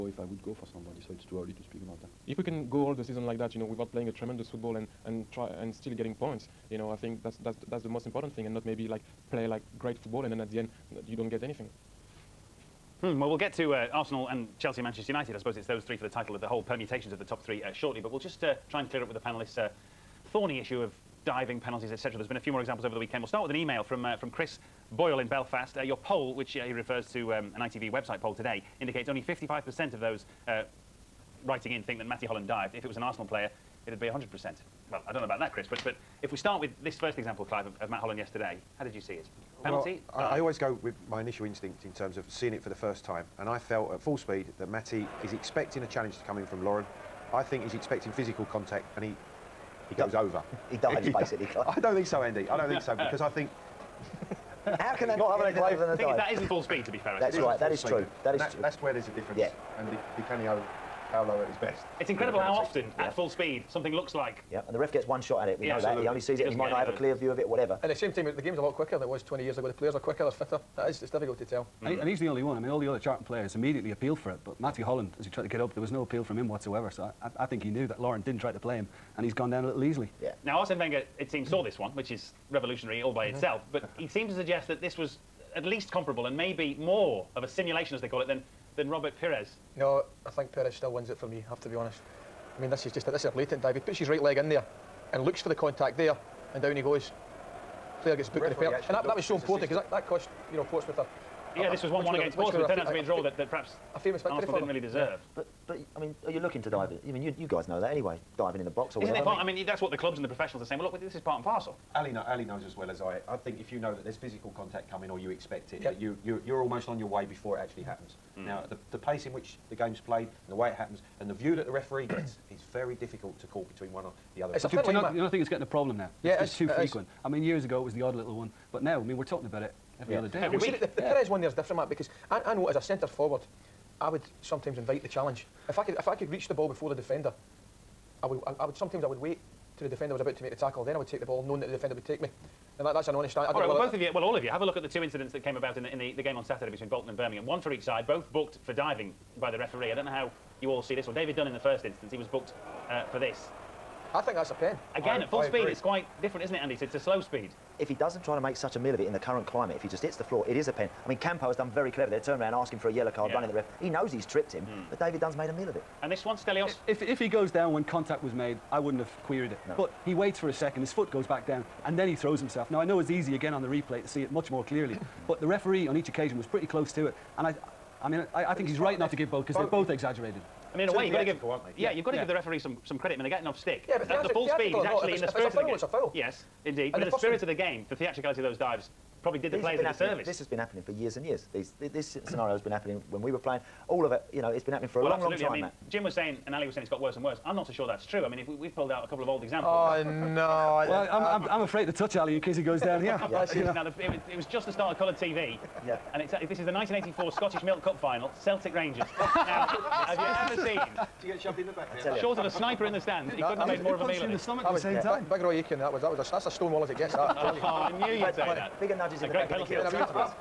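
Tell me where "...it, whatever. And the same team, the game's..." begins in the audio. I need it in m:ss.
1:07.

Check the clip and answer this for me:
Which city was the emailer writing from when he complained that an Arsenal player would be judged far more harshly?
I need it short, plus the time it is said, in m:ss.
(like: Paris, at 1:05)
Belfast, at 0:25.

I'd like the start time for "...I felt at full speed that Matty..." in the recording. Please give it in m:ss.
0:43.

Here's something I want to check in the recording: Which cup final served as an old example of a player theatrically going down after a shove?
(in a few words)
1984 Scottish Milk Cup final.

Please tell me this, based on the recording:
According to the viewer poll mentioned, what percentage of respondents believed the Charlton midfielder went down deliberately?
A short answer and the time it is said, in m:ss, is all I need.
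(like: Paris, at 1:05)
55%, at 0:29.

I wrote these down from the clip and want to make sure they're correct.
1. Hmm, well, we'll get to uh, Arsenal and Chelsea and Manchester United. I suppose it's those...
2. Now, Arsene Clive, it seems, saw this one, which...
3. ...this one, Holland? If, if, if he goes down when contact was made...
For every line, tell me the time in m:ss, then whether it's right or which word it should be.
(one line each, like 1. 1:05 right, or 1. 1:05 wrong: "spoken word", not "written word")
1. 0:13 right
2. 1:20 wrong: "Wenger", not "Clive"
3. 2:46 wrong: "Stelios", not "Holland".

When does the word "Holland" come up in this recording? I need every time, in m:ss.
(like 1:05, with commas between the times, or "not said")
0:32, 0:37, 1:14.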